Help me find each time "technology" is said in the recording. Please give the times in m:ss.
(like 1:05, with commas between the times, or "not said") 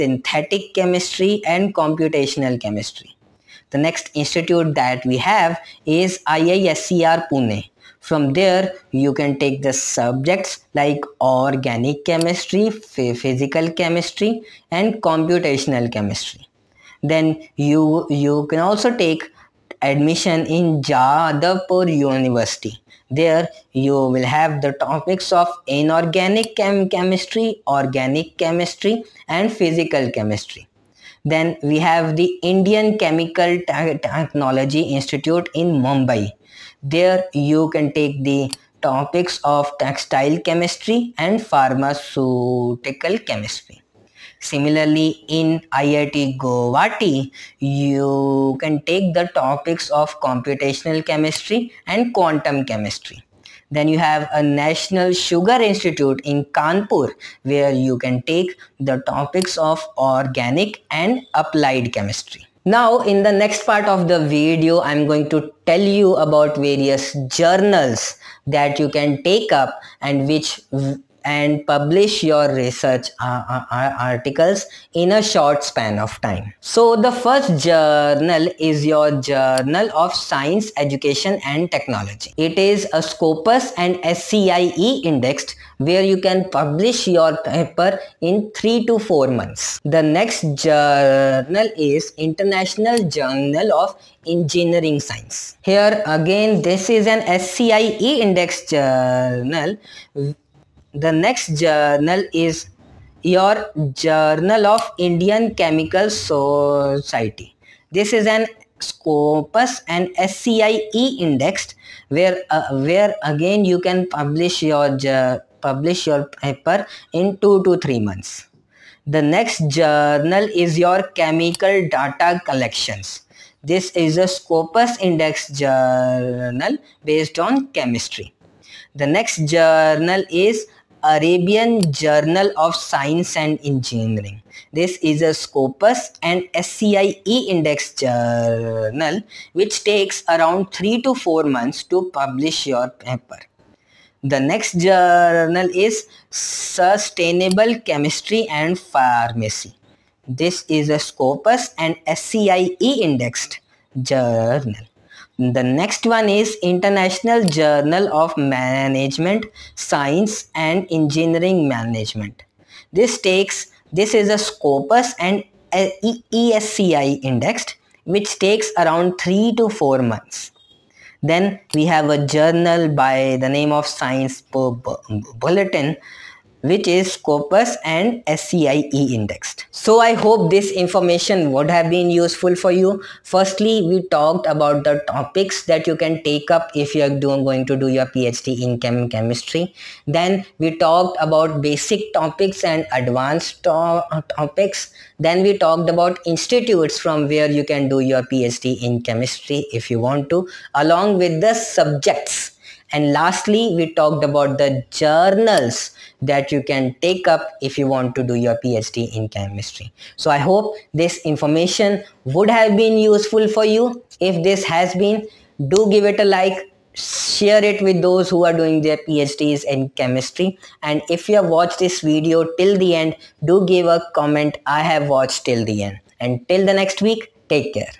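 0:34, 1:21.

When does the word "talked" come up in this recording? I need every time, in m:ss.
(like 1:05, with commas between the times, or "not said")
3:04, 3:10, 3:15, 3:23.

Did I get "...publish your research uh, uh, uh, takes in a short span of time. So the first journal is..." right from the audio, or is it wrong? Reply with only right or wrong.
wrong.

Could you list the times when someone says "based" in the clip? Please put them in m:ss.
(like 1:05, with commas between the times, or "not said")
2:07.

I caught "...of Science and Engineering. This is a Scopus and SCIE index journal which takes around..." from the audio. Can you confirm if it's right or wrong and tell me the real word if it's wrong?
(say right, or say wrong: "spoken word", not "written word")
right.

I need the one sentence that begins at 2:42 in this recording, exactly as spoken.
This takes, this is a Scopus and ESCI indexed which takes around 3 to 4 months.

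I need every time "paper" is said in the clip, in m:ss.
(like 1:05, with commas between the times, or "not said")
1:27, 1:56, 2:22.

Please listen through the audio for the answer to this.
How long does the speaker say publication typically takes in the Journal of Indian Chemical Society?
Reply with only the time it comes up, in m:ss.
1:57.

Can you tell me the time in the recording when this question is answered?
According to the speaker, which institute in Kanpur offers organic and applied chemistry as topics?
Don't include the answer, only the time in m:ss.
0:54.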